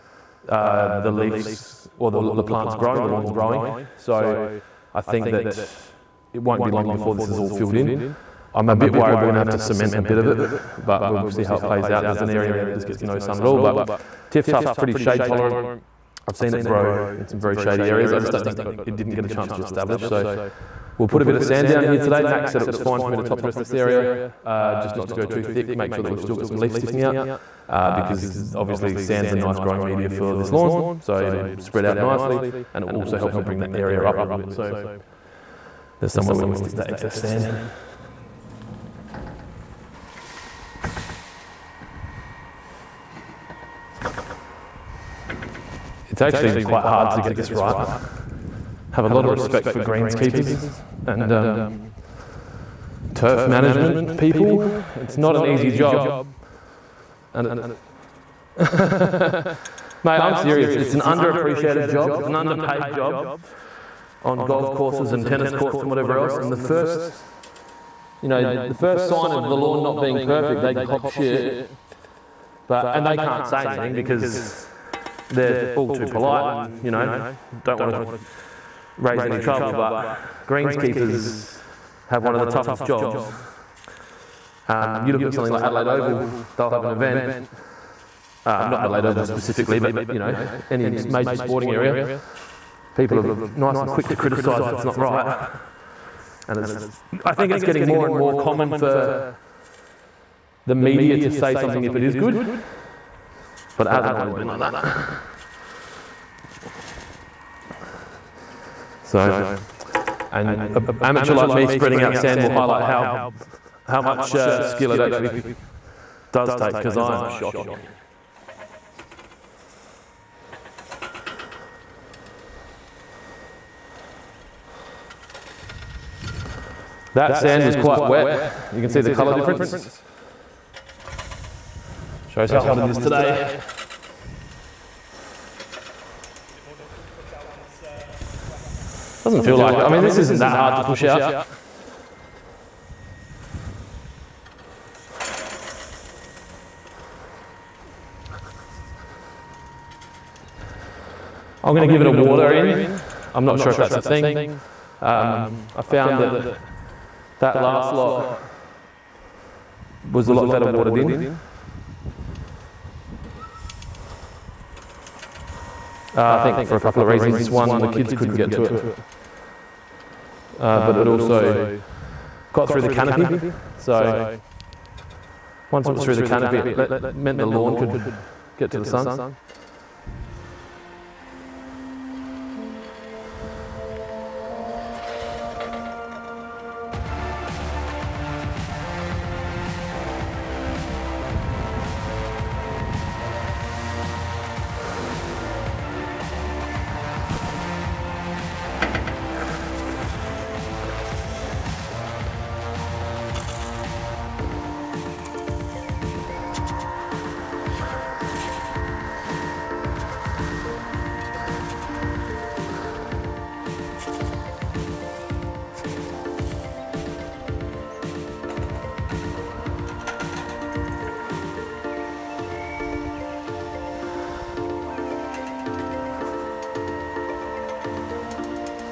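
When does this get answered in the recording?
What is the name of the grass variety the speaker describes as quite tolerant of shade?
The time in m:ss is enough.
0:14.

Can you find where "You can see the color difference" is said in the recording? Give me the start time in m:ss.
2:08.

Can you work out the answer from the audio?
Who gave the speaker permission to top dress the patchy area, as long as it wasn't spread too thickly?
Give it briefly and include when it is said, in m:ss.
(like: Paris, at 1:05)
Max, at 0:22.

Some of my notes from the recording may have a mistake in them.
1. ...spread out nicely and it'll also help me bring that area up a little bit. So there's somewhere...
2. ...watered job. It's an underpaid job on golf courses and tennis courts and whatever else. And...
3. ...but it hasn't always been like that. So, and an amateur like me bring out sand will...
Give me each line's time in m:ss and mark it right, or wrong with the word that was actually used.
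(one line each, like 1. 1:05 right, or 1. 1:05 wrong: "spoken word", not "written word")
1. 0:31 right
2. 1:01 wrong: "underappreciated", not "watered"
3. 1:43 wrong: "spreading", not "bring".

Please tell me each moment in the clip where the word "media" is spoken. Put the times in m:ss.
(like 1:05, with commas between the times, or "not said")
0:29, 1:40.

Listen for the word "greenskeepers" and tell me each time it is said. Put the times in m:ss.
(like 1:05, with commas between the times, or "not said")
0:49, 1:20.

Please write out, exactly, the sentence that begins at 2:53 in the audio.
So once it was through the canopy, it let, meant the lawn could get to the sun.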